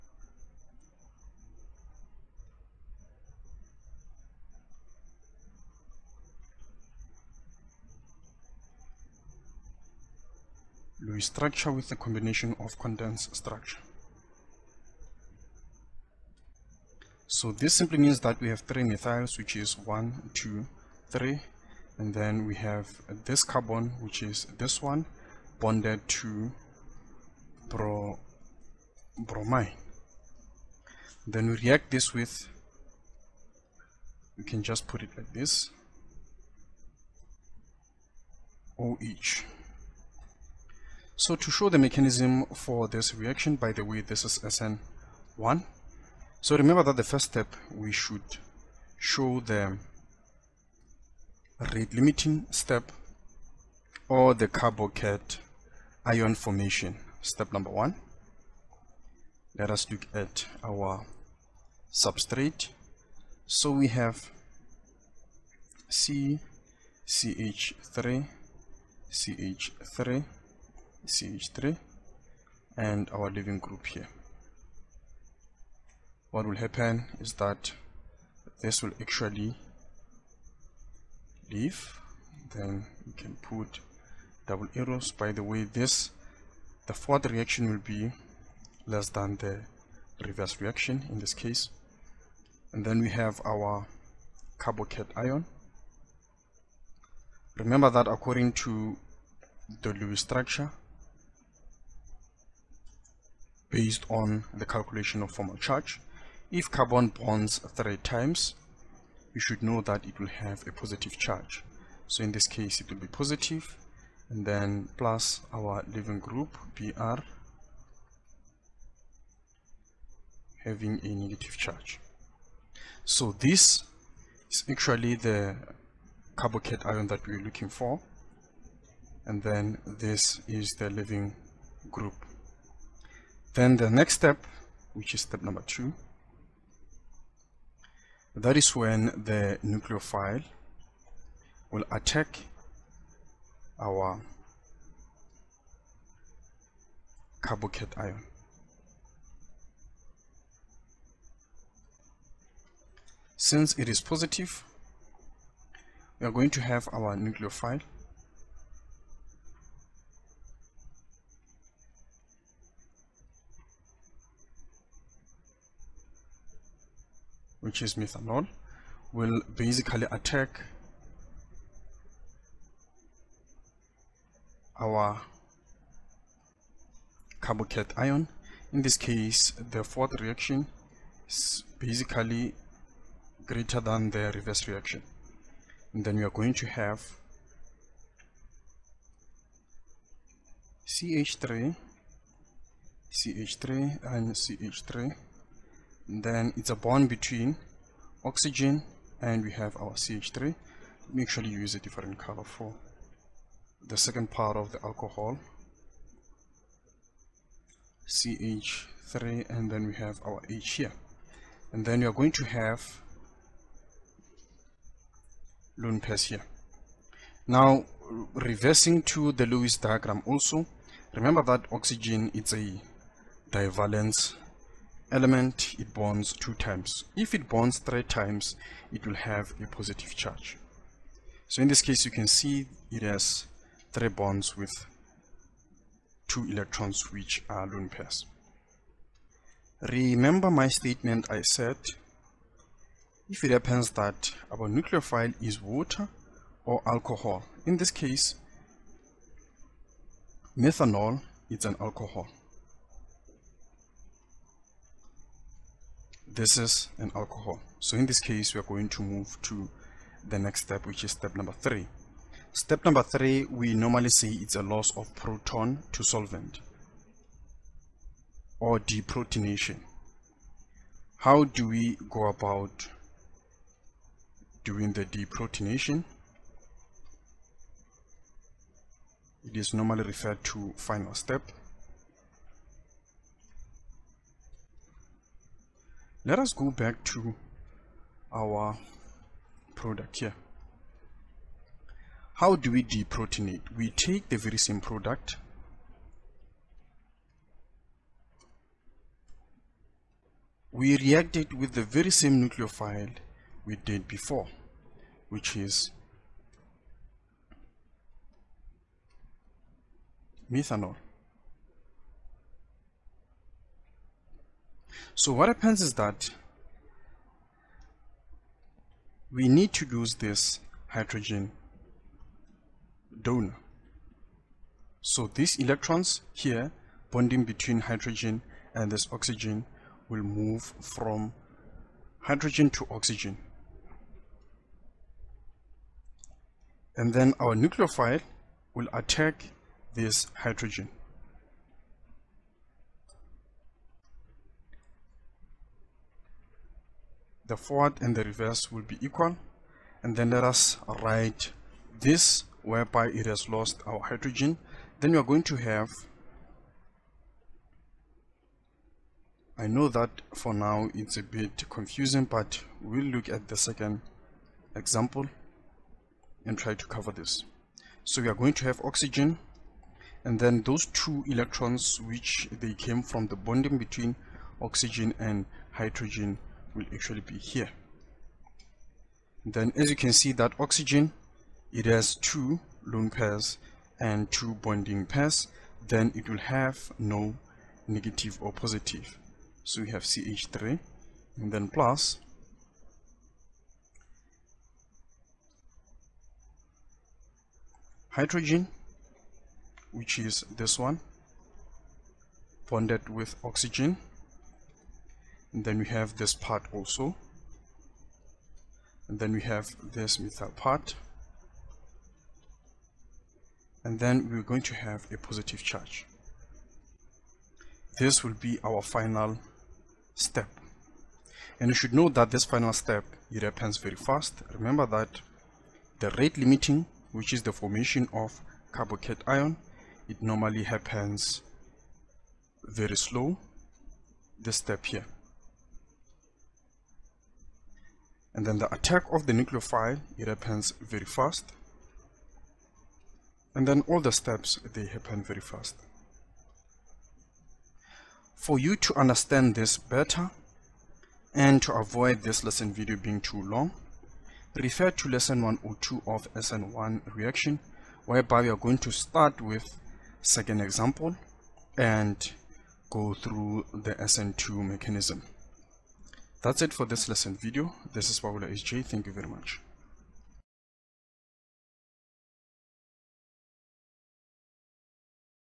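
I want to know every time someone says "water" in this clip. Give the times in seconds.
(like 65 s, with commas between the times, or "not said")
245 s.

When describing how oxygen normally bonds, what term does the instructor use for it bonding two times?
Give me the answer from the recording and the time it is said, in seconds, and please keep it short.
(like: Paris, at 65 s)
divalence, at 223 s.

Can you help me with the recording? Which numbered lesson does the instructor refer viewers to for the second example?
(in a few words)
102.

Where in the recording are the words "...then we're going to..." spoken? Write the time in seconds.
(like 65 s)
413 s.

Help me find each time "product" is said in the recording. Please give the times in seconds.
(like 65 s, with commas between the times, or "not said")
289 s, 294 s.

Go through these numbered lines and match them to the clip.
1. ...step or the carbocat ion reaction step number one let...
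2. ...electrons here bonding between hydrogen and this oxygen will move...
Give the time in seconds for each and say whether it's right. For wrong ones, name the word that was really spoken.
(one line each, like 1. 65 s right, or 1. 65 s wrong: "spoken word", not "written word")
1. 52 s wrong: "formation", not "reaction"
2. 325 s right.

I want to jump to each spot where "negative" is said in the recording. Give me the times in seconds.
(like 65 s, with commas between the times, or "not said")
121 s, 387 s.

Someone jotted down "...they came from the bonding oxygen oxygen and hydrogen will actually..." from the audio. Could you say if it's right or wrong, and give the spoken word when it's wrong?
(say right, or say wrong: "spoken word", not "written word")
wrong: "between", not "oxygen".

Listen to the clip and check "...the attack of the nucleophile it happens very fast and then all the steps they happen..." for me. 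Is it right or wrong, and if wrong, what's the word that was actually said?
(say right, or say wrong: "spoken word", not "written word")
right.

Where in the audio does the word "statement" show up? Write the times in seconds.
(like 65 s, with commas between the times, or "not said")
240 s.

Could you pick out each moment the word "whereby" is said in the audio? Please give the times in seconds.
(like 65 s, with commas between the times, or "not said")
352 s, 458 s.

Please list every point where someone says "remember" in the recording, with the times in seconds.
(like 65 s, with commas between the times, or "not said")
46 s, 97 s, 221 s, 239 s, 424 s.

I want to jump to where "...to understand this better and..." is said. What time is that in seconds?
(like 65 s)
448 s.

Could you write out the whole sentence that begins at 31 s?
Then we react this with, we can just put it like this, OH.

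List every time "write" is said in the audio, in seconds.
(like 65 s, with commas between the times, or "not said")
351 s.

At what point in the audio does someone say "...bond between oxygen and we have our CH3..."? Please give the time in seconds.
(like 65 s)
196 s.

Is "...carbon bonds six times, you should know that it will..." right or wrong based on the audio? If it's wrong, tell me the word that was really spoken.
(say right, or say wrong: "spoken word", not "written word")
wrong: "three", not "six".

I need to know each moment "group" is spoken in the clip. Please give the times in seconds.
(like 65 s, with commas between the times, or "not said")
73 s, 116 s, 131 s.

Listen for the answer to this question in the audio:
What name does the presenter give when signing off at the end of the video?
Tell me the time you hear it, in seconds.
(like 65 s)
468 s.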